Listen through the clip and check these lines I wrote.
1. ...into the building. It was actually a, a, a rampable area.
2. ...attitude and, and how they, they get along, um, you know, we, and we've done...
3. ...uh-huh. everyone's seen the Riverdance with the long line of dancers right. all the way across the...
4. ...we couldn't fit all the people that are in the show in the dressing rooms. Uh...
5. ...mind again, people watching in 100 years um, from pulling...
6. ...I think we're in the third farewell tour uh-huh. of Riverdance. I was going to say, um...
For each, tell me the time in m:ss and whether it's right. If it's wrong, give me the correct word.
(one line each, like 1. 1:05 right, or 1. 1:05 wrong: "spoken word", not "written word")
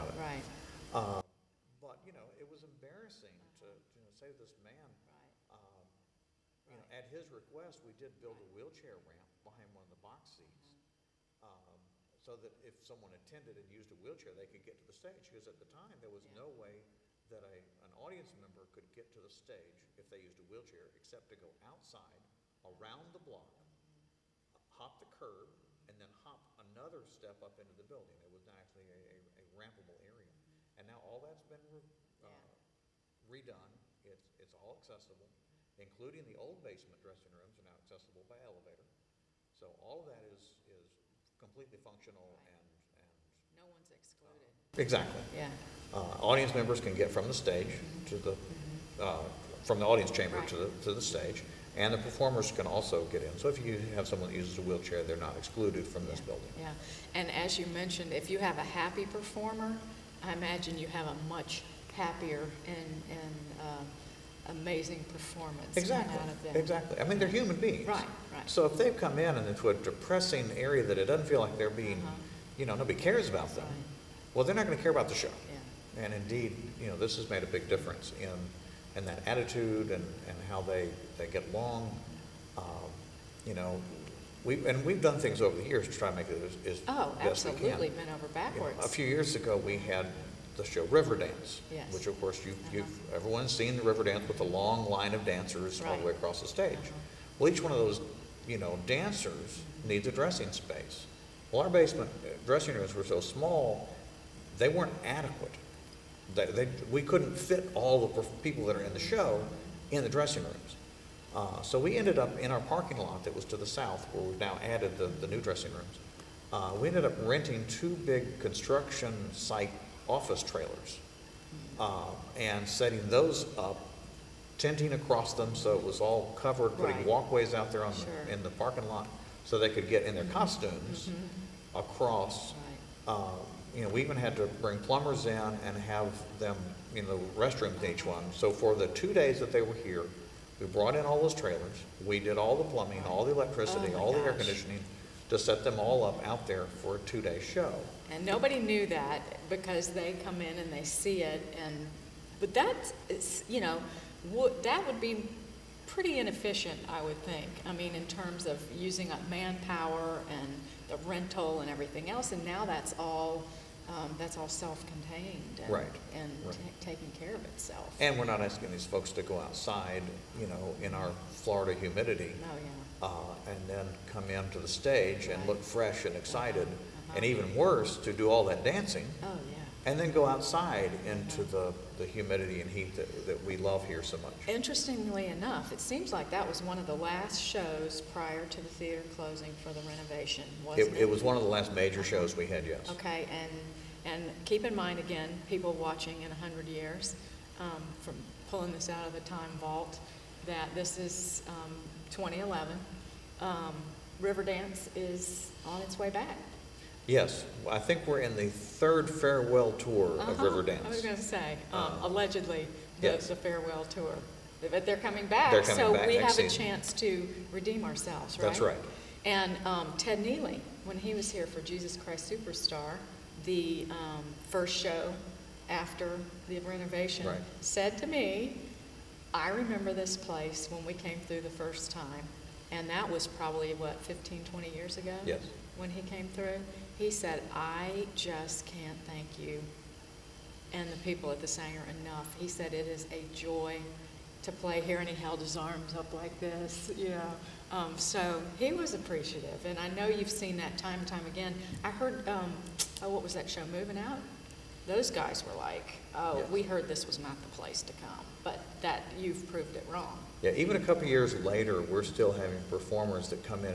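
1. 0:27 right
2. 1:19 right
3. 1:32 right
4. 1:46 right
5. 3:14 right
6. 3:27 right.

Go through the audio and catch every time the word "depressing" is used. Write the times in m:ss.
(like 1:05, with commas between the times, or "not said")
1:09.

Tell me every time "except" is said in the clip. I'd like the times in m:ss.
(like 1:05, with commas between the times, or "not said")
0:20.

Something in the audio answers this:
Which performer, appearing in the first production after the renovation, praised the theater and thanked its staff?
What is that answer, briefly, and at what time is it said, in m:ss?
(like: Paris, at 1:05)
Ted Neeley, at 3:39.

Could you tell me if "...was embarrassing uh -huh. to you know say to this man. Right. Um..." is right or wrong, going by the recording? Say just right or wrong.
right.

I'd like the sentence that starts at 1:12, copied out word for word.
you know, nobody cares about them, right.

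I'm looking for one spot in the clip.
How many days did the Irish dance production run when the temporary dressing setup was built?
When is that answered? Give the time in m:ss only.
2:18.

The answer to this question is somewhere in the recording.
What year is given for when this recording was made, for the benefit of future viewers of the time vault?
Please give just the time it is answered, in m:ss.
3:22.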